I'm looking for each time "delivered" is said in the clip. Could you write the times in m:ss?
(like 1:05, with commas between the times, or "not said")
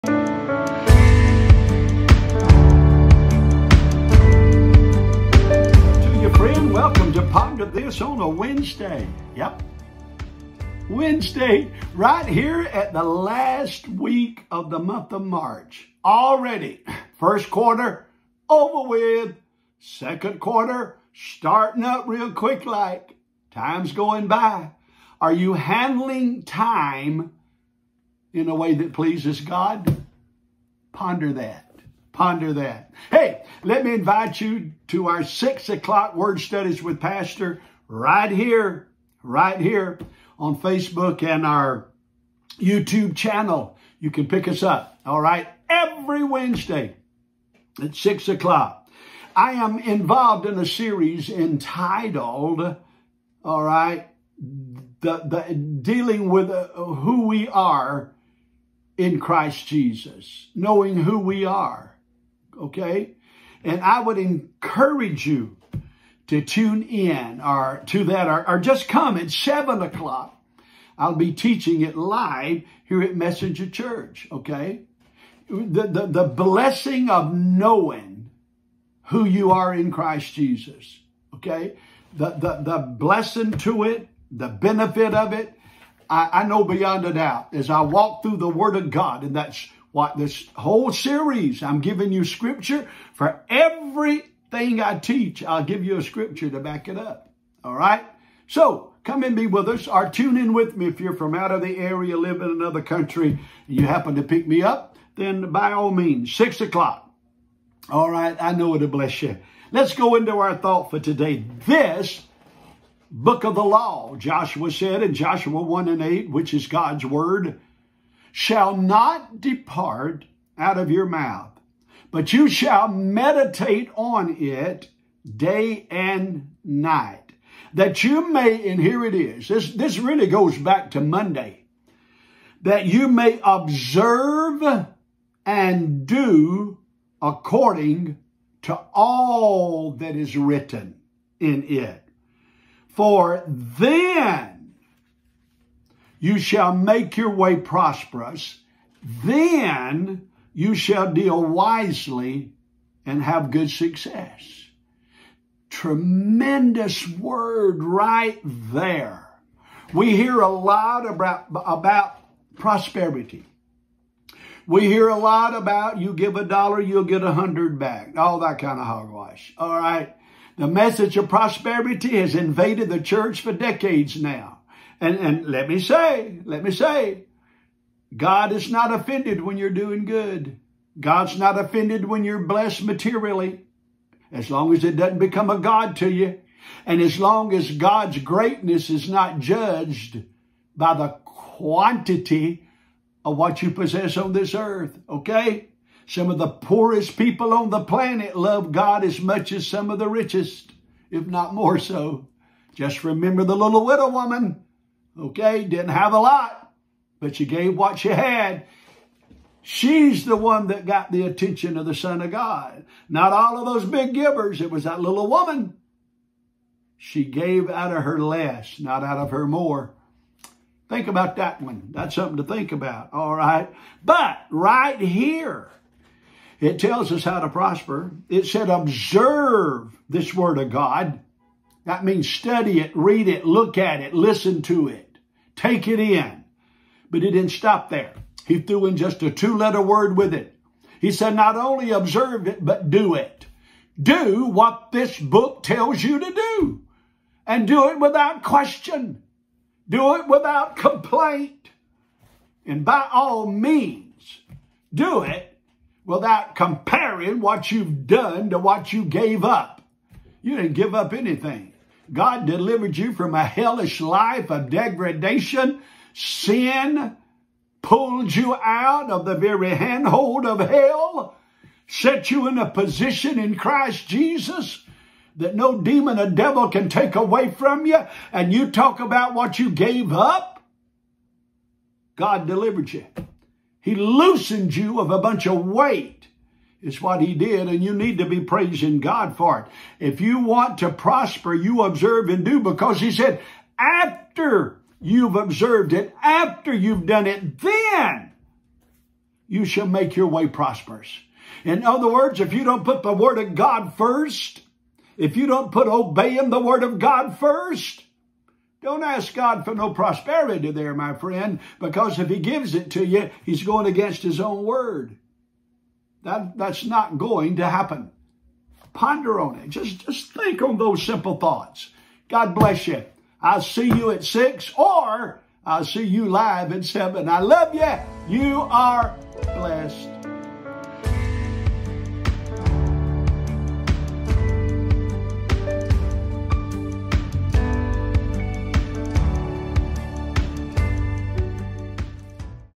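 4:22, 4:42.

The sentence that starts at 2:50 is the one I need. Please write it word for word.
The message of prosperity has invaded the church for decades now.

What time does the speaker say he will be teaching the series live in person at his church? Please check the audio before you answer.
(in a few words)
7 o'clock.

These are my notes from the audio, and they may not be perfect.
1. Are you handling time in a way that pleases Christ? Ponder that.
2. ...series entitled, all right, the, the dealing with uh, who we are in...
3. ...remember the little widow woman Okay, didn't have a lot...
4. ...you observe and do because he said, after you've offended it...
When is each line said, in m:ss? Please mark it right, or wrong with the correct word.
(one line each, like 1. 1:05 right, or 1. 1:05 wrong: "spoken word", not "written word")
1. 0:25 wrong: "God", not "Christ"
2. 0:50 right
3. 3:23 right
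4. 4:51 wrong: "observed", not "offended".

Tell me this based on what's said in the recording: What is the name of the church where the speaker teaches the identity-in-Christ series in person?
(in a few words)
Messenger Church.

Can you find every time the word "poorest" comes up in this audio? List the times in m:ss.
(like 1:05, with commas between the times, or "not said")
3:16.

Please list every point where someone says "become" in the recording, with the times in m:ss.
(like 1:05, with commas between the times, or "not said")
3:05.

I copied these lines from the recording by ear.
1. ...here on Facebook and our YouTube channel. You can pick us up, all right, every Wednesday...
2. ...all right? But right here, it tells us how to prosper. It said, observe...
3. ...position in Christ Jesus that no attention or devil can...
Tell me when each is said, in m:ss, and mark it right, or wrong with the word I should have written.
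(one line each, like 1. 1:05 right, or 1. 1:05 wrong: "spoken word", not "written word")
1. 0:39 right
2. 3:43 right
3. 4:32 wrong: "demon", not "attention".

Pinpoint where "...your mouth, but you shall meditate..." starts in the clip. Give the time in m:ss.
2:00.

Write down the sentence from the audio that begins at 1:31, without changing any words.
I'm giving you scripture for everything I teach.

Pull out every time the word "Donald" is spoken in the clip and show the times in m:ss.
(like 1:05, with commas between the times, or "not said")
not said.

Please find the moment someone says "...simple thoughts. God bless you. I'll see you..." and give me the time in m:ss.
5:21.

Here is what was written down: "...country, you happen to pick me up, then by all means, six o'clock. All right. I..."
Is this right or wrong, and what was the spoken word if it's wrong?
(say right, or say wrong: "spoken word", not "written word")
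right.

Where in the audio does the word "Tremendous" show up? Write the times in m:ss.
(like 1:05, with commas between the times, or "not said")
2:35.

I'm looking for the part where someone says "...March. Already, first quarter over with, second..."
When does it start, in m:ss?
0:15.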